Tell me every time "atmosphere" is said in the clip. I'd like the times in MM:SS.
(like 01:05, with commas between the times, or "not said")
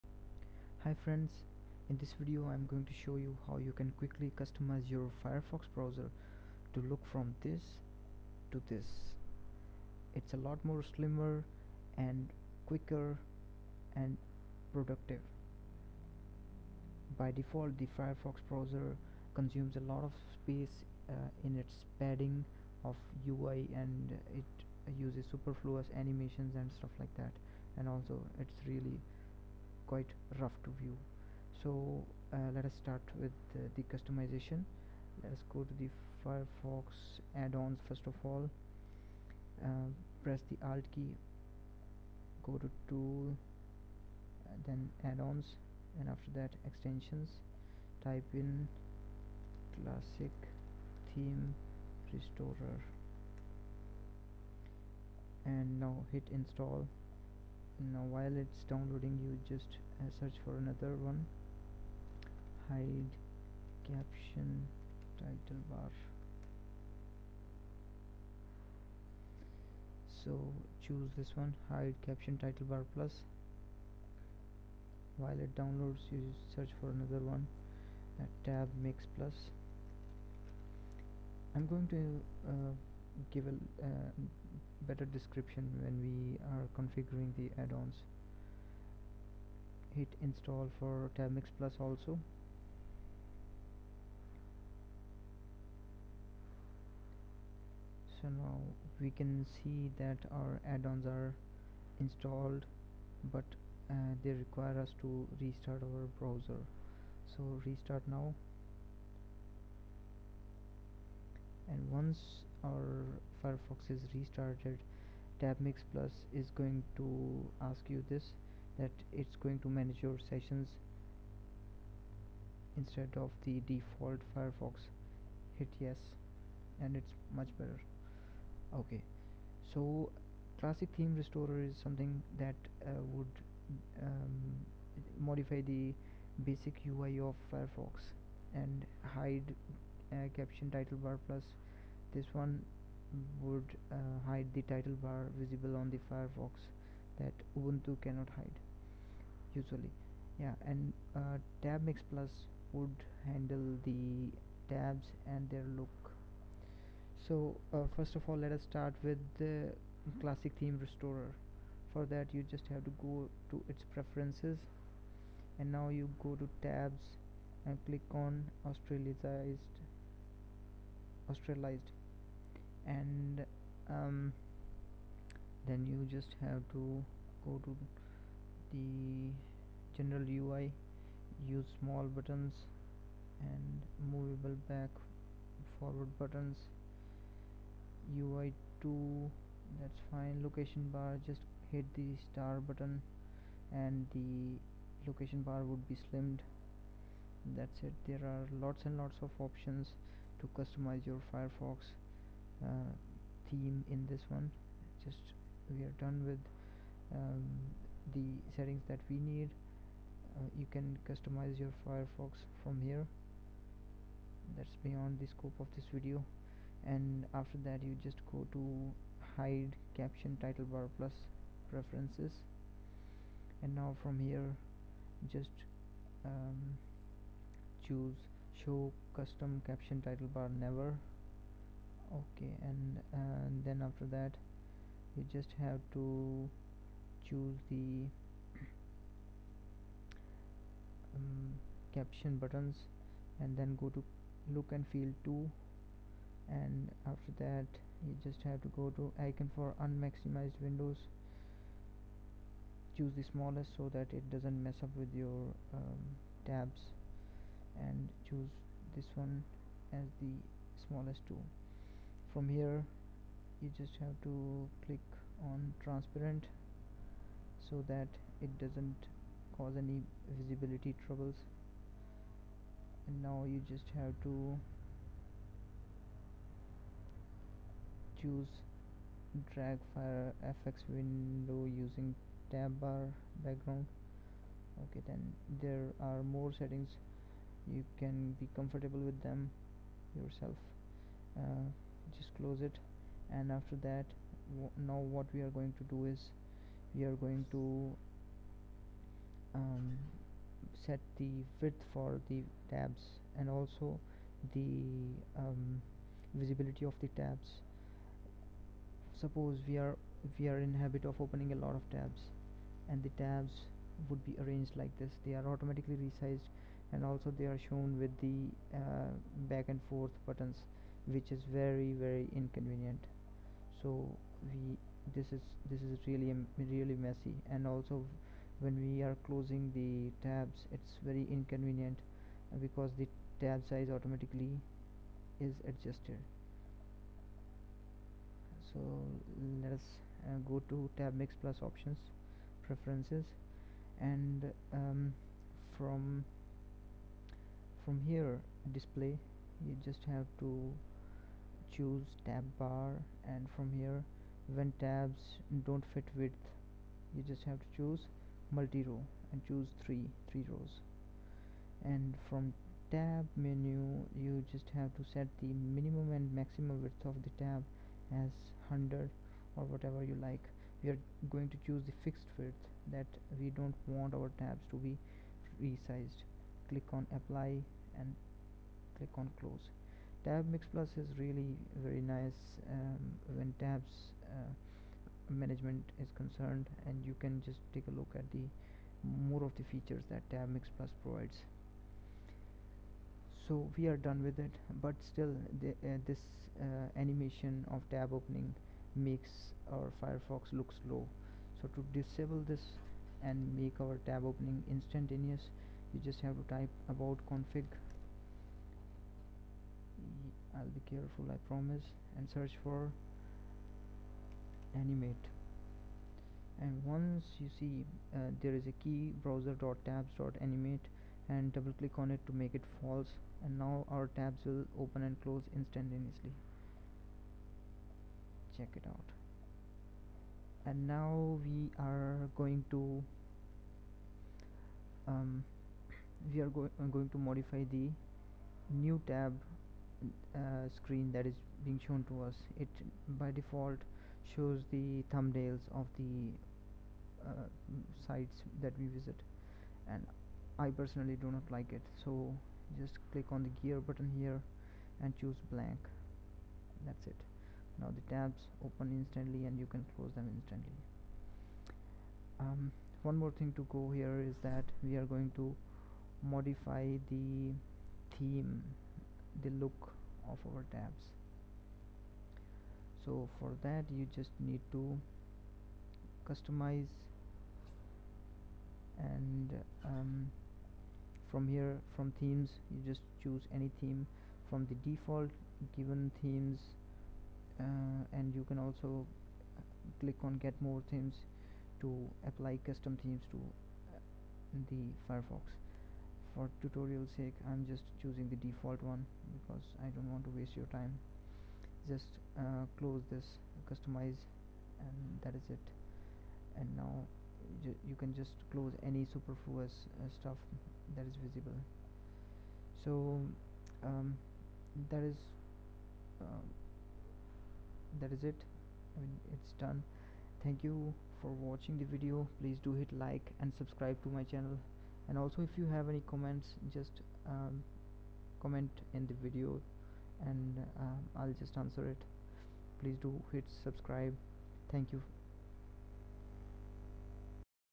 not said.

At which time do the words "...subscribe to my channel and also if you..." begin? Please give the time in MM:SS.
08:43.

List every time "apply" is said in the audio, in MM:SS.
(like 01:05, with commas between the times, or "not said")
06:17, 08:12.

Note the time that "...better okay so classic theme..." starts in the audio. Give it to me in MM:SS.
02:07.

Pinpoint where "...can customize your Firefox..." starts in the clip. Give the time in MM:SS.
03:30.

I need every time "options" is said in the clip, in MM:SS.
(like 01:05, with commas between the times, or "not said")
03:19, 05:41.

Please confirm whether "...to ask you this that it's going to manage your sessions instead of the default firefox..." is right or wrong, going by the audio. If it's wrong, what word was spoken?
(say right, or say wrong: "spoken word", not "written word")
right.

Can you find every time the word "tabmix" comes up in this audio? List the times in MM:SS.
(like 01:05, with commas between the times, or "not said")
01:31, 01:55.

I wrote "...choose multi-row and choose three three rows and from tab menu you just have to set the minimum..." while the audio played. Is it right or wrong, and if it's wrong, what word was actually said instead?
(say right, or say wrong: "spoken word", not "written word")
right.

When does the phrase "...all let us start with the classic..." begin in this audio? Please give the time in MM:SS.
02:38.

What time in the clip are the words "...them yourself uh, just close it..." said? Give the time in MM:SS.
04:49.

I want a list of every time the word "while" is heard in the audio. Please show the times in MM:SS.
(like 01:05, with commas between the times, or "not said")
00:58, 01:15.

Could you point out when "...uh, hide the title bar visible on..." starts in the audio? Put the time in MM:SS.
02:23.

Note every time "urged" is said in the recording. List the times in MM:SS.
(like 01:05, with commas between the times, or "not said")
not said.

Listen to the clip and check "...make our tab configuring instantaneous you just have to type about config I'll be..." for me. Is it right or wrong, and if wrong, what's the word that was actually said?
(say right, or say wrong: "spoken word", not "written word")
wrong: "opening", not "configuring".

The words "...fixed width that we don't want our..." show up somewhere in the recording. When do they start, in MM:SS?
06:12.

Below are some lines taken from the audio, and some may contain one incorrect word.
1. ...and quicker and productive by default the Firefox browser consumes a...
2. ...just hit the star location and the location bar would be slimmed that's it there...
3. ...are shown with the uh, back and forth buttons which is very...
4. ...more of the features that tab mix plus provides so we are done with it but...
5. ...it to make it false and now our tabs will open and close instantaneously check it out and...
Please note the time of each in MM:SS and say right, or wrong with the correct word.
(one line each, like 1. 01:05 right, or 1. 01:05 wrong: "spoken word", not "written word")
1. 00:11 right
2. 03:11 wrong: "button", not "location"
3. 05:17 right
4. 06:29 right
5. 07:02 right.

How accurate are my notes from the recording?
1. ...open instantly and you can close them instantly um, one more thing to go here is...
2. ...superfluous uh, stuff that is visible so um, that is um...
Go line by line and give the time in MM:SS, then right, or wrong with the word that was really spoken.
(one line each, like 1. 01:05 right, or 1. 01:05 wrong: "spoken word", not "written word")
1. 07:38 right
2. 08:29 right.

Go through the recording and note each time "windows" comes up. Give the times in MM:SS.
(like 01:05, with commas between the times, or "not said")
04:10, 04:40.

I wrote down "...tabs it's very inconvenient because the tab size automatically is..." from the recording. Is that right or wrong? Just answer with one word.
right.